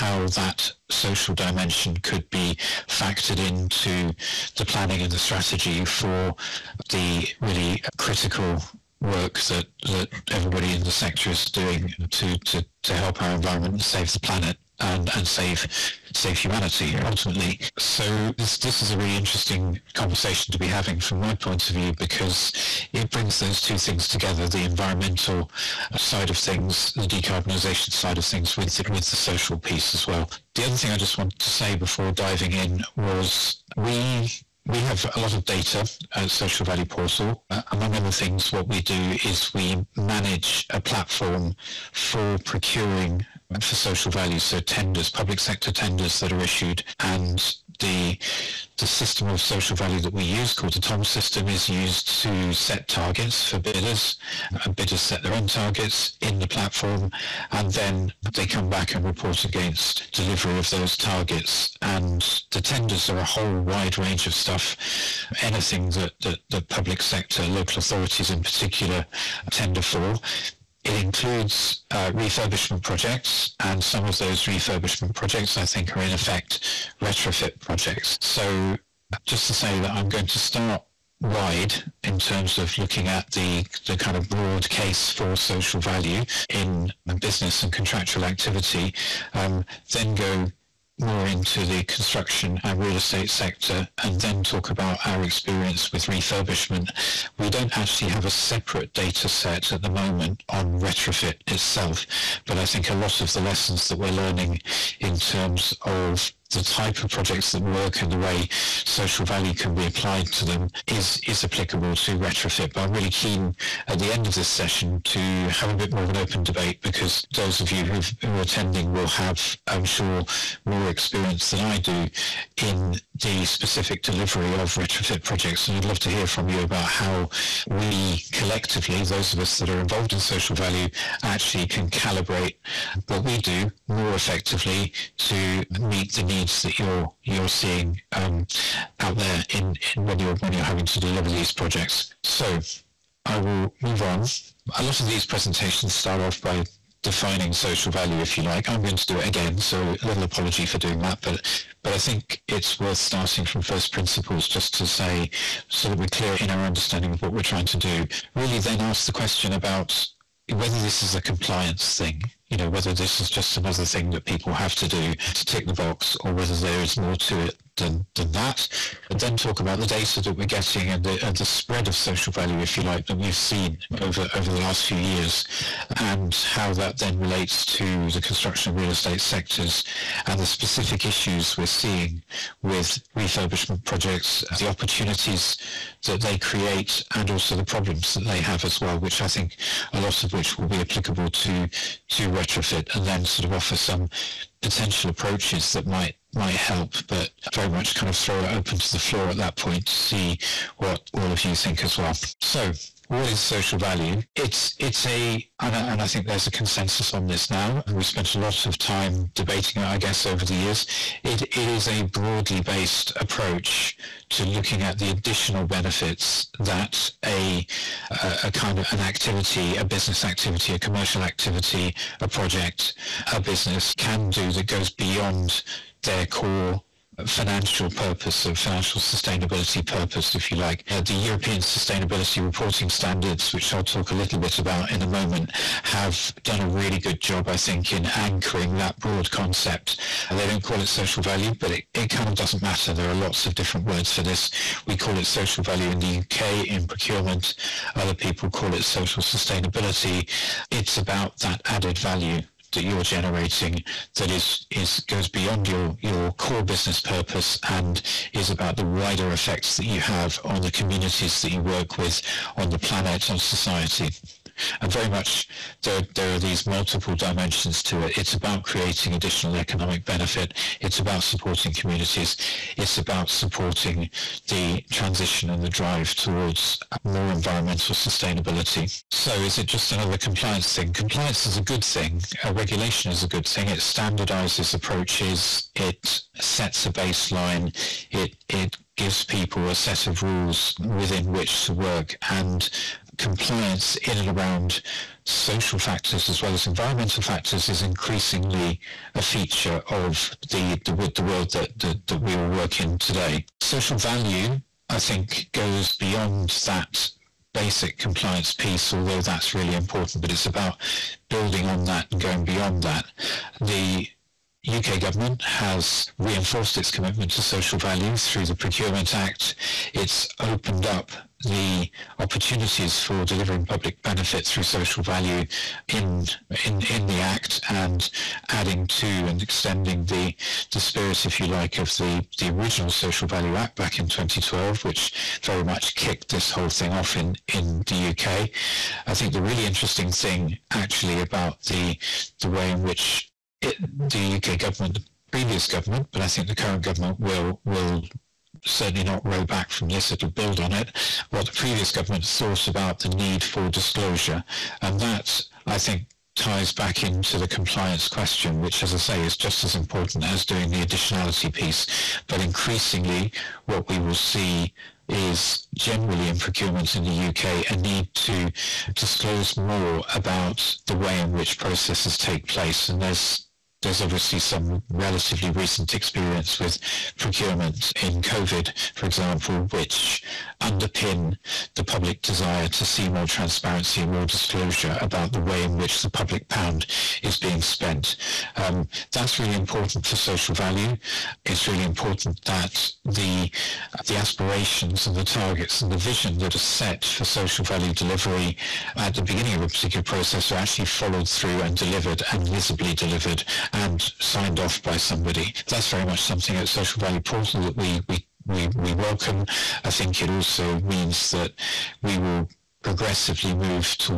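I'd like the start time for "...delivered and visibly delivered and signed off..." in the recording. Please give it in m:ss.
6:41.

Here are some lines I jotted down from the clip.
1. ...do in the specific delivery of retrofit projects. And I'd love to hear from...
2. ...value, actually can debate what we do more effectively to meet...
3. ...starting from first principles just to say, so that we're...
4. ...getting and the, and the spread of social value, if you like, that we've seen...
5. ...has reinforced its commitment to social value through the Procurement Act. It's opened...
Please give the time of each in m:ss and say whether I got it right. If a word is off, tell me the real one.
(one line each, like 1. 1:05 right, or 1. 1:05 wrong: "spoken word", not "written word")
1. 2:01 right
2. 2:10 wrong: "calibrate", not "debate"
3. 2:32 right
4. 2:50 right
5. 5:15 right.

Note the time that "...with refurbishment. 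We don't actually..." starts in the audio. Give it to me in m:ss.
1:35.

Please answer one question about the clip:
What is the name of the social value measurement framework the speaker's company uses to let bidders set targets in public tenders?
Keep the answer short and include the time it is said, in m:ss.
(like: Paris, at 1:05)
TOM system, at 0:50.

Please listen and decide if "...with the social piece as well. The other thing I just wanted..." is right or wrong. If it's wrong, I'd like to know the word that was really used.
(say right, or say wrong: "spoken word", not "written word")
right.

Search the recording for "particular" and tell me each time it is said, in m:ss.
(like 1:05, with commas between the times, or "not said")
1:08, 6:39.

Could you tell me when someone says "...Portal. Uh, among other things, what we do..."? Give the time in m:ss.
0:36.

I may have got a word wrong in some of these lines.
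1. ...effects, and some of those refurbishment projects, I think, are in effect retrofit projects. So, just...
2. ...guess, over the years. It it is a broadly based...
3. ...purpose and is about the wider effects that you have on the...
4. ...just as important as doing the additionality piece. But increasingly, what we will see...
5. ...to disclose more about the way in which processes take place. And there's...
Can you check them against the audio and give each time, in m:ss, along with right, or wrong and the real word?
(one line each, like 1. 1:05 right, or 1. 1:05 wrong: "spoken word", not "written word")
1. 1:12 wrong: "projects", not "effects"
2. 3:29 right
3. 4:16 right
4. 5:59 right
5. 6:08 right.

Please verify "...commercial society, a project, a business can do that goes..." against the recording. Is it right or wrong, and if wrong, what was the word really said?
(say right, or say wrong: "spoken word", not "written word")
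wrong: "activity", not "society".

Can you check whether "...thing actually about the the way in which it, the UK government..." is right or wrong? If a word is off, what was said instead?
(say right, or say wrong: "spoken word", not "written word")
right.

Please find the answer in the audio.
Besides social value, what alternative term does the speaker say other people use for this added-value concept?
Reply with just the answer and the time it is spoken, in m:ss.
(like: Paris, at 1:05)
social sustainability, at 4:08.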